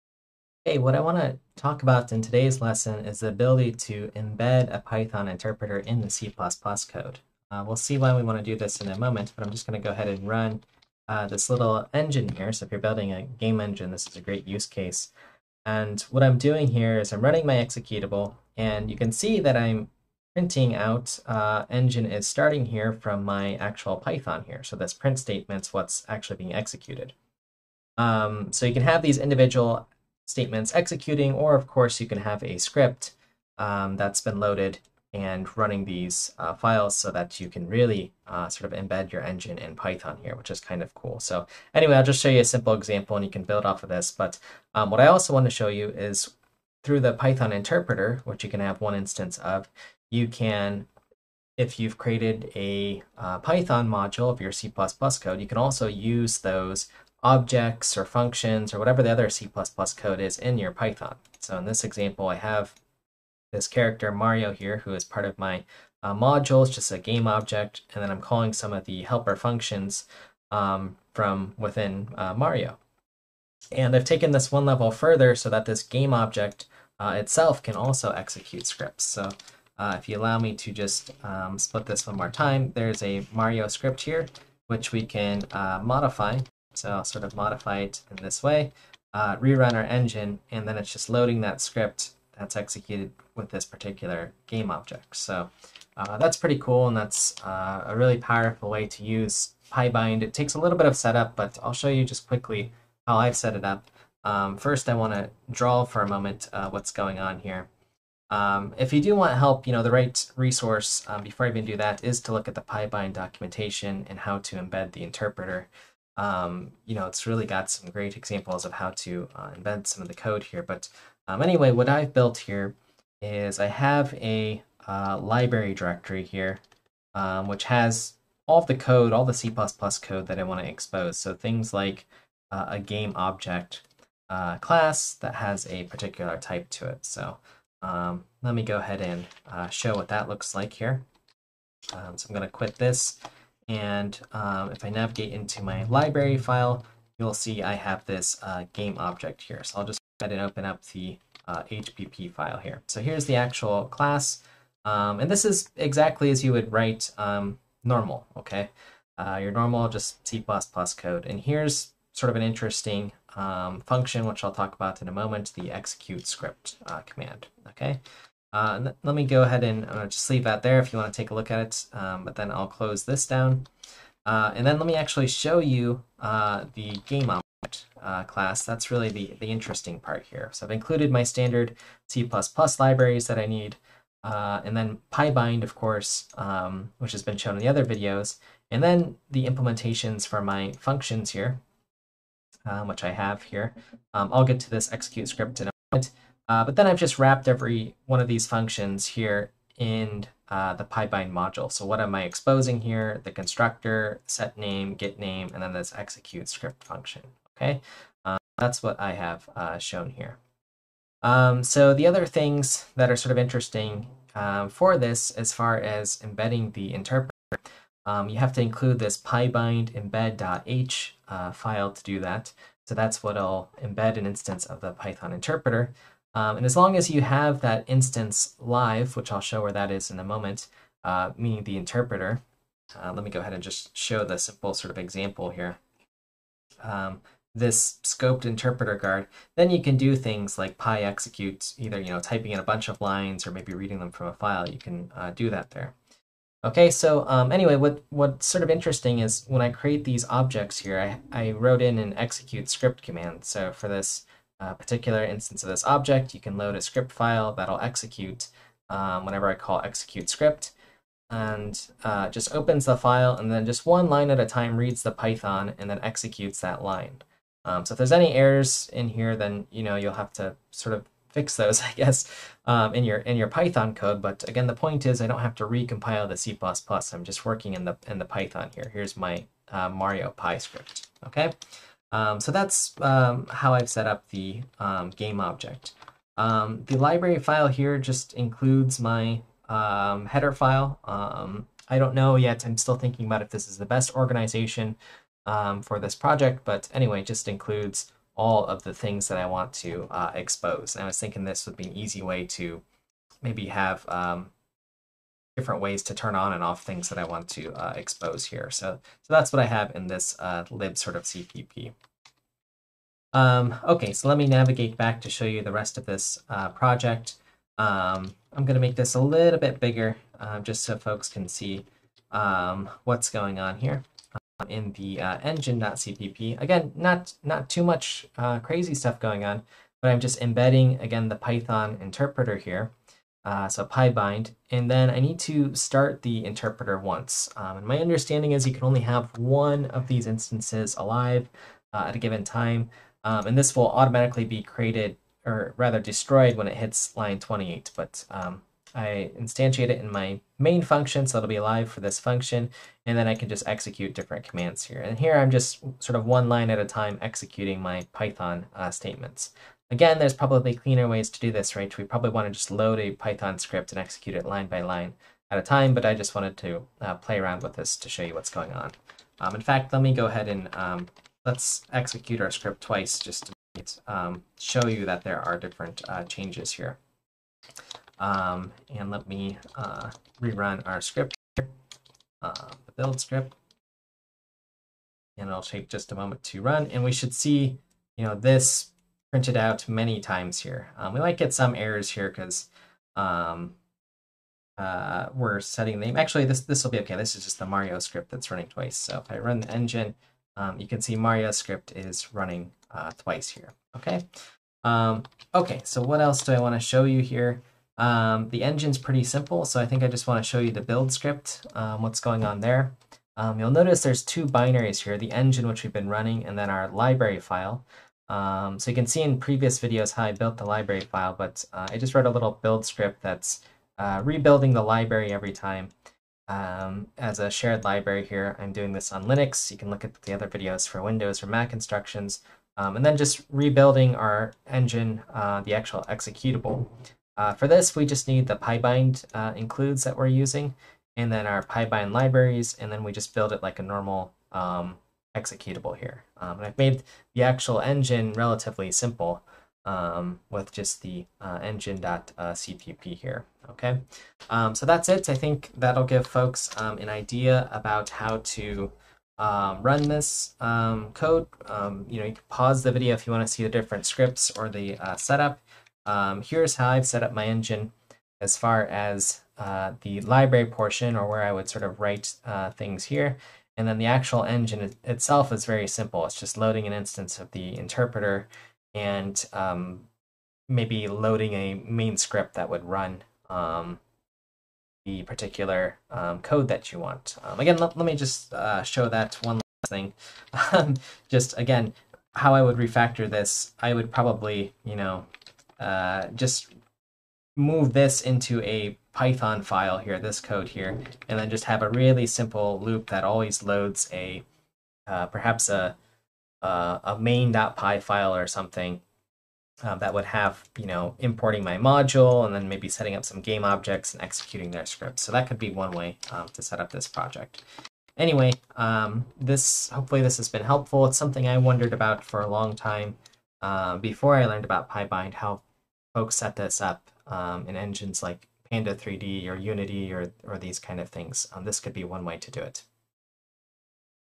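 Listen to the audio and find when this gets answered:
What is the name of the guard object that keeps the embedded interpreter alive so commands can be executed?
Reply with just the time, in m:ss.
3:58.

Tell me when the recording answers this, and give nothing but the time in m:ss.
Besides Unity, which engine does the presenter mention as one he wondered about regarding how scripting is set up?
8:48.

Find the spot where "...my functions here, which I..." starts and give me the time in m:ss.
3:10.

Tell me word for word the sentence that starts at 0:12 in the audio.
So if you're building a game engine, this is a great use case.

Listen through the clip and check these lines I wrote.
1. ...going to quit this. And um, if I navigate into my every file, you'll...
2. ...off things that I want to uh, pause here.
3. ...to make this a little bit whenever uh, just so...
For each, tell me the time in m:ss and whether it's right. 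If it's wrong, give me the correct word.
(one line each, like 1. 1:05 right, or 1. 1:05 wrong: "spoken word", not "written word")
1. 2:22 wrong: "library", not "every"
2. 5:06 wrong: "expose", not "pause"
3. 5:18 wrong: "bigger", not "whenever".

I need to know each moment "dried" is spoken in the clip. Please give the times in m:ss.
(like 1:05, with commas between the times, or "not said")
not said.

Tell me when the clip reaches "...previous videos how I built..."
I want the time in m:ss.
6:59.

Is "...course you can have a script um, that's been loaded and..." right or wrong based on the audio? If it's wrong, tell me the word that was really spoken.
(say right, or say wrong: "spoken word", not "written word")
right.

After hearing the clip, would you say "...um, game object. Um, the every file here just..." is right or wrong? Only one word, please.
wrong.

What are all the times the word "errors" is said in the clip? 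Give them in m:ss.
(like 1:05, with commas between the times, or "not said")
4:28, 6:31.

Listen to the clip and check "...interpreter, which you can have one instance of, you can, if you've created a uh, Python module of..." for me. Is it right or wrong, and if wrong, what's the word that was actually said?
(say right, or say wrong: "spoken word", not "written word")
right.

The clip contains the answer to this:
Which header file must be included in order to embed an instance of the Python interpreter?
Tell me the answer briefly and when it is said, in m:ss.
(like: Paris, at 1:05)
pybind embed.h, at 3:39.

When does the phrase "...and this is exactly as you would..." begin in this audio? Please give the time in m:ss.
2:35.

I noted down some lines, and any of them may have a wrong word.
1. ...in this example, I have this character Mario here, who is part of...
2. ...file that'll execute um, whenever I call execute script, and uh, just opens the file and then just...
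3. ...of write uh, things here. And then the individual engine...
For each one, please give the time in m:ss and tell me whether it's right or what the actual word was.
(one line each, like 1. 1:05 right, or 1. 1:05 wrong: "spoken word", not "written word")
1. 1:01 right
2. 4:17 right
3. 7:51 wrong: "actual", not "individual".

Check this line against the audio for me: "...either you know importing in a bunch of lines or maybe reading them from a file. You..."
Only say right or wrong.
wrong.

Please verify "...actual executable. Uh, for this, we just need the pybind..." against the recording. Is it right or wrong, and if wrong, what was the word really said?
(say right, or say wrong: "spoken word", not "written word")
right.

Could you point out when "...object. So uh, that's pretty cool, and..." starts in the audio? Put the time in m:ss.
1:34.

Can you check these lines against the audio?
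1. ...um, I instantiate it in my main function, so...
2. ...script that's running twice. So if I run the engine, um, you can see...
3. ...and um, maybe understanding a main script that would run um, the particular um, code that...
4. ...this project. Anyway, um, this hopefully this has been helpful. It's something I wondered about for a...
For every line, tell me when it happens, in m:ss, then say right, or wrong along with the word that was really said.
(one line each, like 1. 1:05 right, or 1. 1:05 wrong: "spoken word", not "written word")
1. 5:48 right
2. 6:37 right
3. 7:58 wrong: "loading", not "understanding"
4. 8:36 right.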